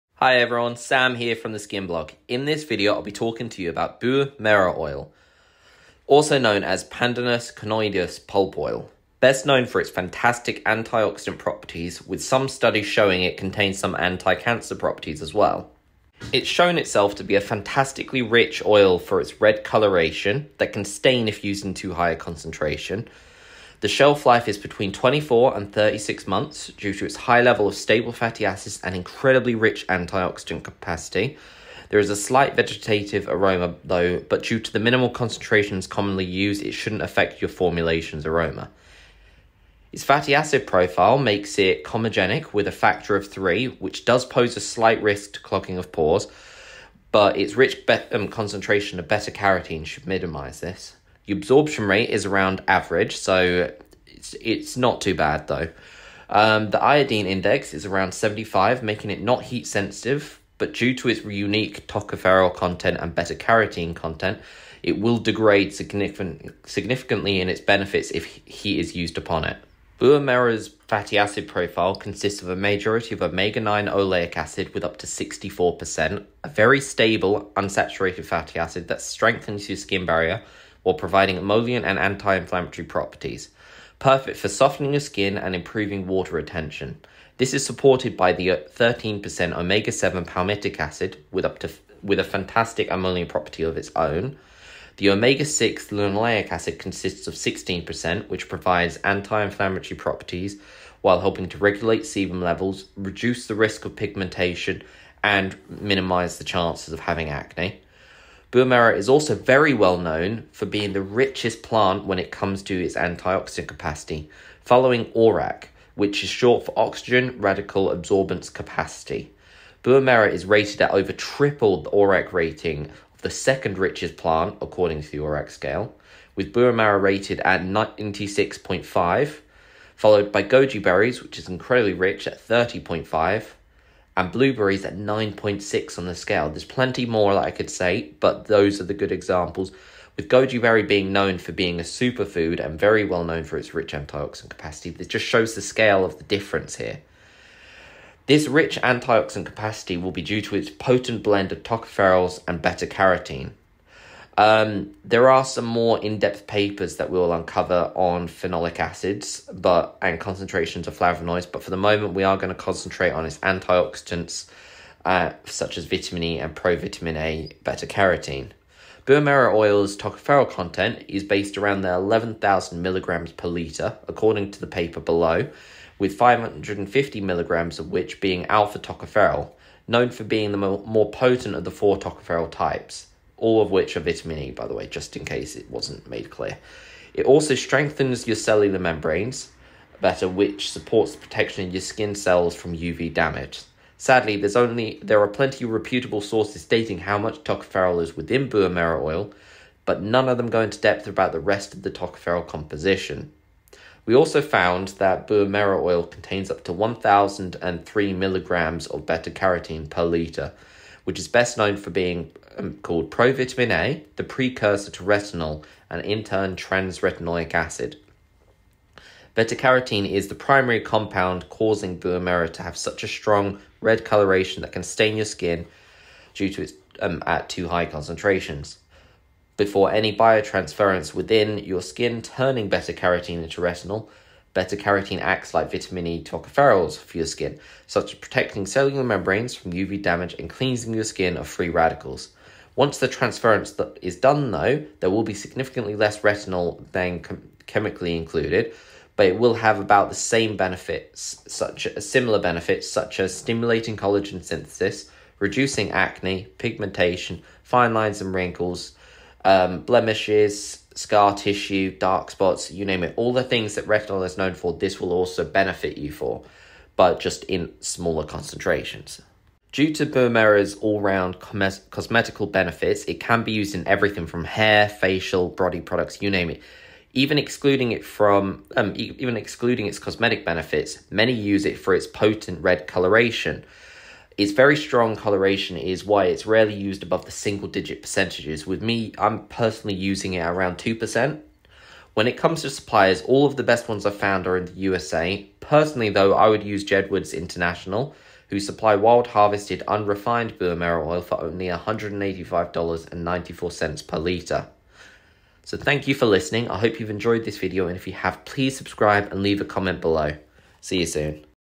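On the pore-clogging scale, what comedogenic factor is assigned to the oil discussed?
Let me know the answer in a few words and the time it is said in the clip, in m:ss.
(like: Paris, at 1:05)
3, at 0:42.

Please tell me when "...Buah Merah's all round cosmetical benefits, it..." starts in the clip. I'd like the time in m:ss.
4:30.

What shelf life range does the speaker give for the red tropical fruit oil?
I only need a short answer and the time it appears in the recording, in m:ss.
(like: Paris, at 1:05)
24 to 36 months, at 0:24.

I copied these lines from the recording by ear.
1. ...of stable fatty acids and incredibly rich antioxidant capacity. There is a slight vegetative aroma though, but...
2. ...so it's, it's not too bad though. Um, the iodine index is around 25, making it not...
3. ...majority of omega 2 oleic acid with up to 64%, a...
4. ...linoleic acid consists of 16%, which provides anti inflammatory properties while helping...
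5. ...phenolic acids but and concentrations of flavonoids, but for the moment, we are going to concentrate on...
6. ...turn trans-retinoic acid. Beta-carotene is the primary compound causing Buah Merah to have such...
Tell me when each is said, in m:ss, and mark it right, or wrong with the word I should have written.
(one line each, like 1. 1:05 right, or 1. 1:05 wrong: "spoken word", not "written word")
1. 0:27 right
2. 0:53 wrong: "75", not "25"
3. 1:12 wrong: "9", not "2"
4. 1:35 right
5. 2:38 right
6. 3:36 right.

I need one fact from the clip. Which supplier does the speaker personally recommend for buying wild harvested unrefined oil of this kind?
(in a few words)
Jedwards International.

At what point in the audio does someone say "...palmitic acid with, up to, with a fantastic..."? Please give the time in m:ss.
1:30.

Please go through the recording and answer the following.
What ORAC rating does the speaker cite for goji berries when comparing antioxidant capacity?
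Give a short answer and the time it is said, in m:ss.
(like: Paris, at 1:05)
30.5, at 2:12.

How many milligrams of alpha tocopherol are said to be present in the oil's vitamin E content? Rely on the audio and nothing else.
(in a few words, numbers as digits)
550 milligrams.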